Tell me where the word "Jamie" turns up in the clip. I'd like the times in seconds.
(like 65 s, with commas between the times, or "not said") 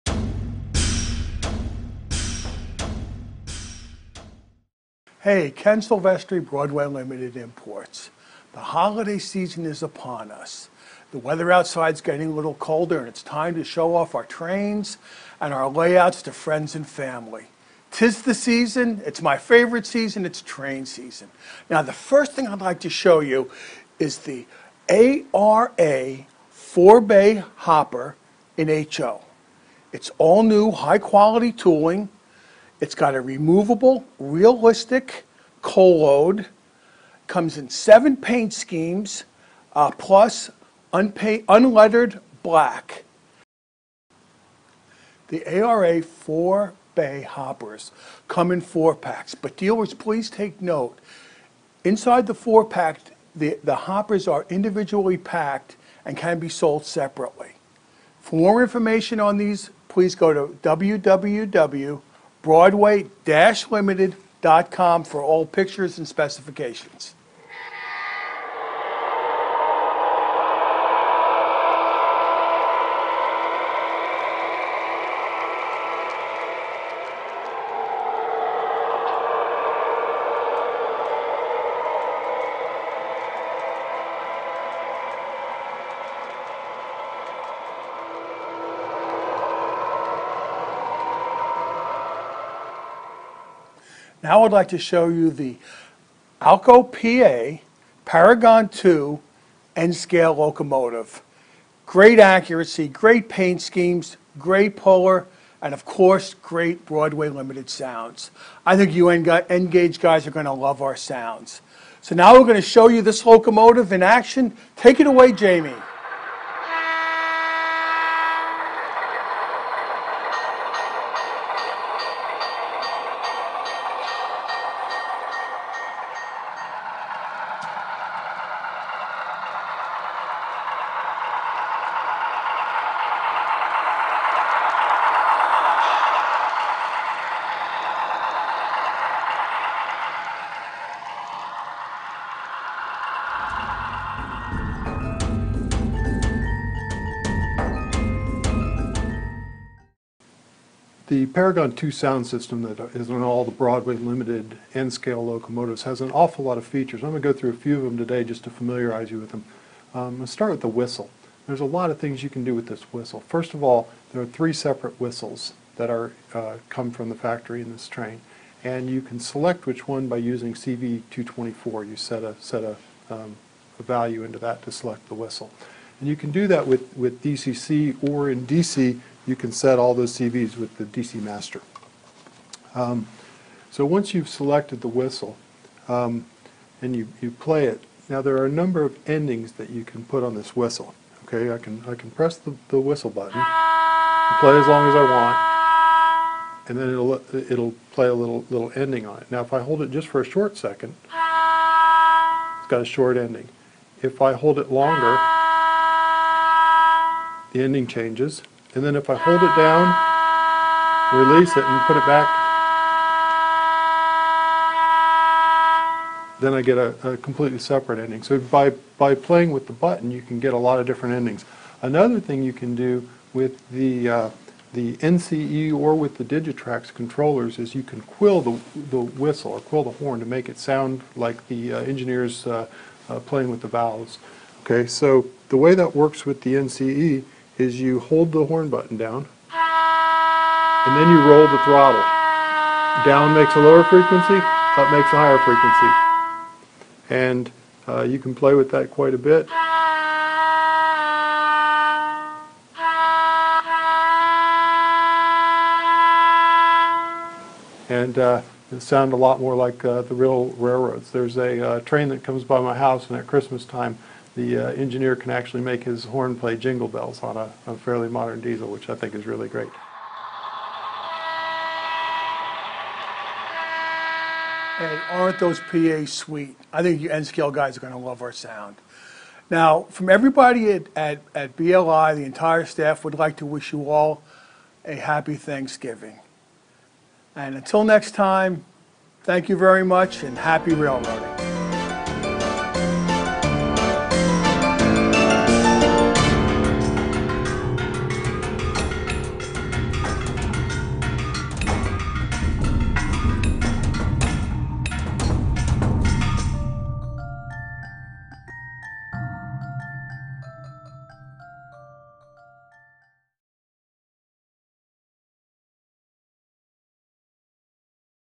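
115 s.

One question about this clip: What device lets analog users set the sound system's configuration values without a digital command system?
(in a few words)
DC master.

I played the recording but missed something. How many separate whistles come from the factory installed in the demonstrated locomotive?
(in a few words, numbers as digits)
3.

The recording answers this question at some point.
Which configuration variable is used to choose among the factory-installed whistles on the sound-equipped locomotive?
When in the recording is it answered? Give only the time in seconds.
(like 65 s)
170 s.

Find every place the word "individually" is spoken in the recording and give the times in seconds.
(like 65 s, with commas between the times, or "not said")
54 s.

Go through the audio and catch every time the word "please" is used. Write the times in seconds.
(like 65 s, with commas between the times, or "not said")
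49 s, 59 s.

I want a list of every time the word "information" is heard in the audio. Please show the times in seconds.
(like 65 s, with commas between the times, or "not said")
58 s.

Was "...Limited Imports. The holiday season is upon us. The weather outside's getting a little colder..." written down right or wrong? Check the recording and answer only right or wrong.
right.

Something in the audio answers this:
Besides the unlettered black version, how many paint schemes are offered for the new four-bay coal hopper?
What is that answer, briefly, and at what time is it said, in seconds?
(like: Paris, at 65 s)
7, at 37 s.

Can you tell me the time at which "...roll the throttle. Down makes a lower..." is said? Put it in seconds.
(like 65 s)
241 s.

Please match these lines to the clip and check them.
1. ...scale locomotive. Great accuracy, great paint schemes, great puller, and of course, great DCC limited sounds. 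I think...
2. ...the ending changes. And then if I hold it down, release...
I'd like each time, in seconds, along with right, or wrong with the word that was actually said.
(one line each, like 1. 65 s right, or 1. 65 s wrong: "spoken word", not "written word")
1. 99 s wrong: "Broadway", not "DCC"
2. 207 s right.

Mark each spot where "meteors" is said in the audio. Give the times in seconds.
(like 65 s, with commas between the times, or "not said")
not said.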